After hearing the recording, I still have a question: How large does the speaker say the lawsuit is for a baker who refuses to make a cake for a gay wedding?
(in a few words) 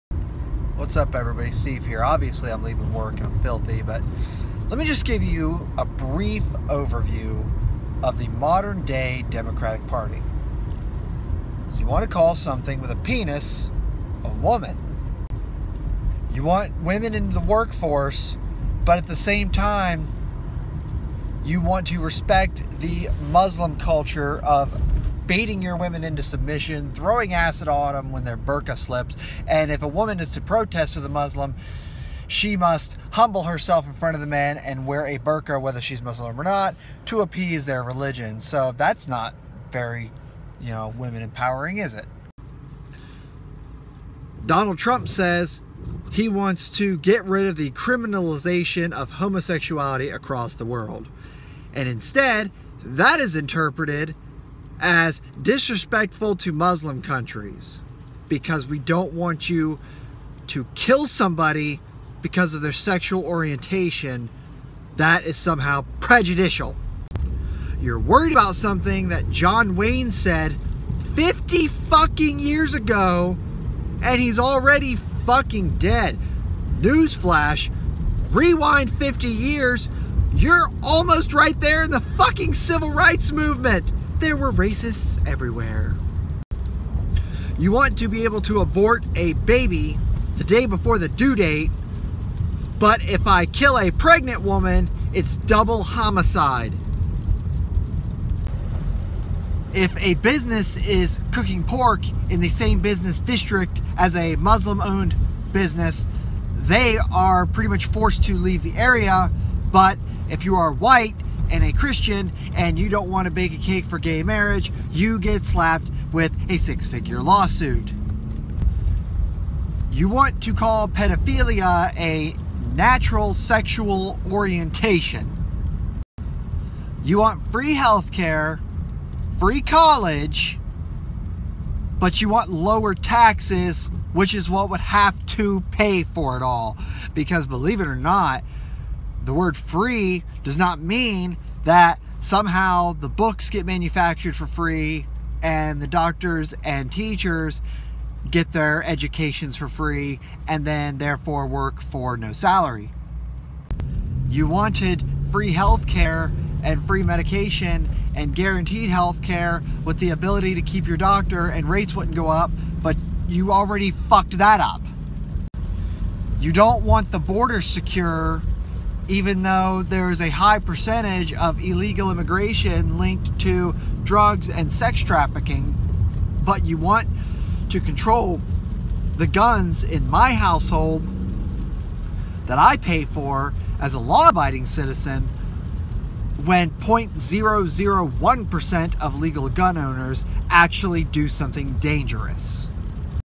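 six figure.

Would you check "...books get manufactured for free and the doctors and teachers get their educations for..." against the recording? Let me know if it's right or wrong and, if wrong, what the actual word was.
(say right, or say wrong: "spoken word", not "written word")
right.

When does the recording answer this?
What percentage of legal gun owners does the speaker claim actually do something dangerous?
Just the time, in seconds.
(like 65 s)
186 s.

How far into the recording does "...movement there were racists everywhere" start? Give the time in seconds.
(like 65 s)
83 s.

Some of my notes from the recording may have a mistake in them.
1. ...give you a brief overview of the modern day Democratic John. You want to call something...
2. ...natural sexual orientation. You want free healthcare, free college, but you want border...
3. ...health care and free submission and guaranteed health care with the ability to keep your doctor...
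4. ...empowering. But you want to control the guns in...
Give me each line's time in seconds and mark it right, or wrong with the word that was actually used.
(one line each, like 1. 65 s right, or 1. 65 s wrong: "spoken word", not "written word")
1. 5 s wrong: "Party", not "John"
2. 122 s wrong: "lower", not "border"
3. 155 s wrong: "medication", not "submission"
4. 175 s wrong: "trafficking", not "empowering".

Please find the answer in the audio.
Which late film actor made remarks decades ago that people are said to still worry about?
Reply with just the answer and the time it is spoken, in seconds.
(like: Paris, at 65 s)
John Wayne, at 69 s.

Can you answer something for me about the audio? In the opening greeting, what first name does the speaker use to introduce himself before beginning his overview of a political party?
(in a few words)
Steve.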